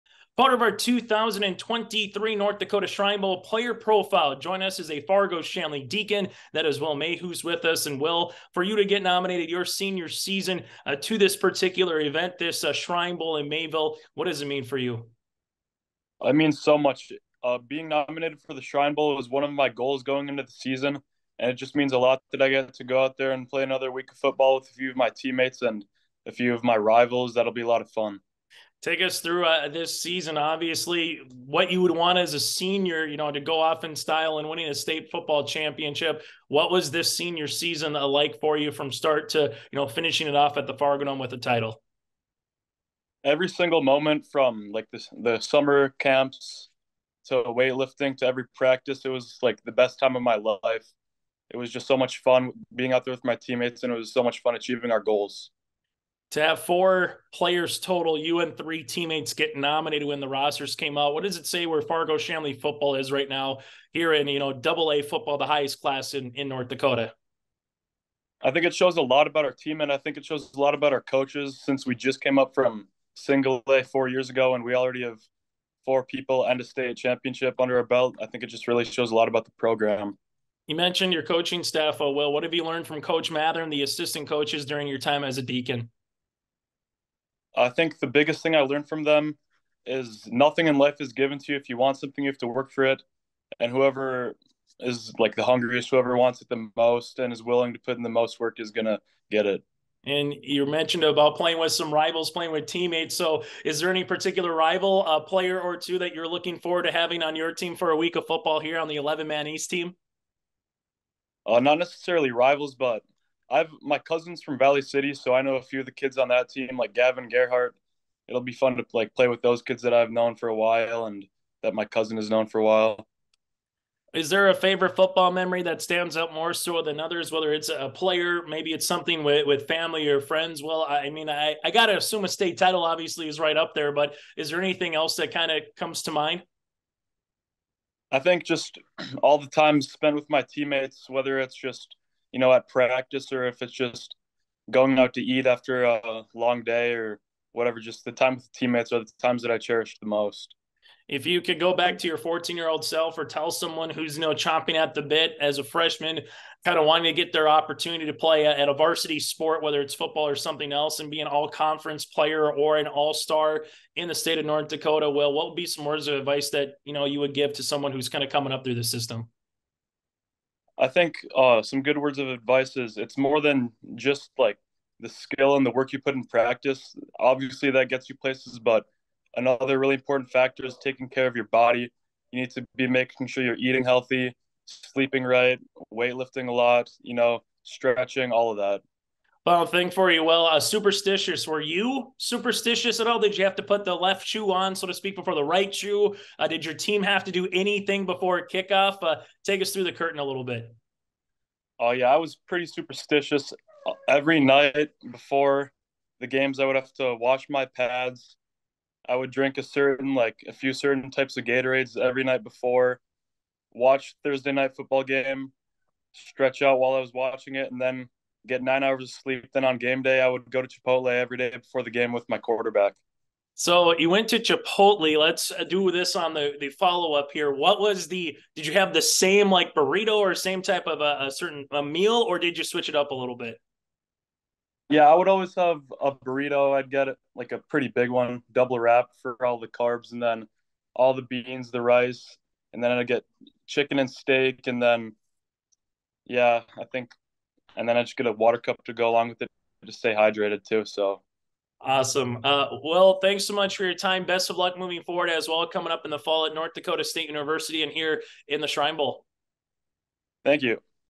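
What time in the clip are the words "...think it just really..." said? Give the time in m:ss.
1:18.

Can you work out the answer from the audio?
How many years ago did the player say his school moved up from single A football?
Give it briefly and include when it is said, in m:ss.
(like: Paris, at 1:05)
4, at 1:13.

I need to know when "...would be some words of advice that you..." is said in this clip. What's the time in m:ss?
2:45.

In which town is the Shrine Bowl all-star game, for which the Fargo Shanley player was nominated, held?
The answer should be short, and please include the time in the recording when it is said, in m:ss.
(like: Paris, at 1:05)
Mayville, at 0:13.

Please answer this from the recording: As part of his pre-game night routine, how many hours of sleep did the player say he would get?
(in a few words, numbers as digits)
9.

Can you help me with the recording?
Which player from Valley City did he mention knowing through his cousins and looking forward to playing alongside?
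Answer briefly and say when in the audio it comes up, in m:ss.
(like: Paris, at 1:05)
Gavin Gerhart, at 1:56.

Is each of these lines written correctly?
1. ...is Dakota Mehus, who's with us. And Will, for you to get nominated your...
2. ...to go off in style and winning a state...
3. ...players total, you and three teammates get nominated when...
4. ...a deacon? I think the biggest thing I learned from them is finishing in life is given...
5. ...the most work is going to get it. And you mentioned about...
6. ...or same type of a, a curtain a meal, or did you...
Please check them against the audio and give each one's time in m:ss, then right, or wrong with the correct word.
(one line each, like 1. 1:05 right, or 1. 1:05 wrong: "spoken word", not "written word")
1. 0:06 wrong: "Will", not "Dakota"
2. 0:33 right
3. 0:57 right
4. 1:25 wrong: "nothing", not "finishing"
5. 1:38 right
6. 3:50 wrong: "certain", not "curtain".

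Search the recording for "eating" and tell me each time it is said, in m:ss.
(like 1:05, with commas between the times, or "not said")
3:03.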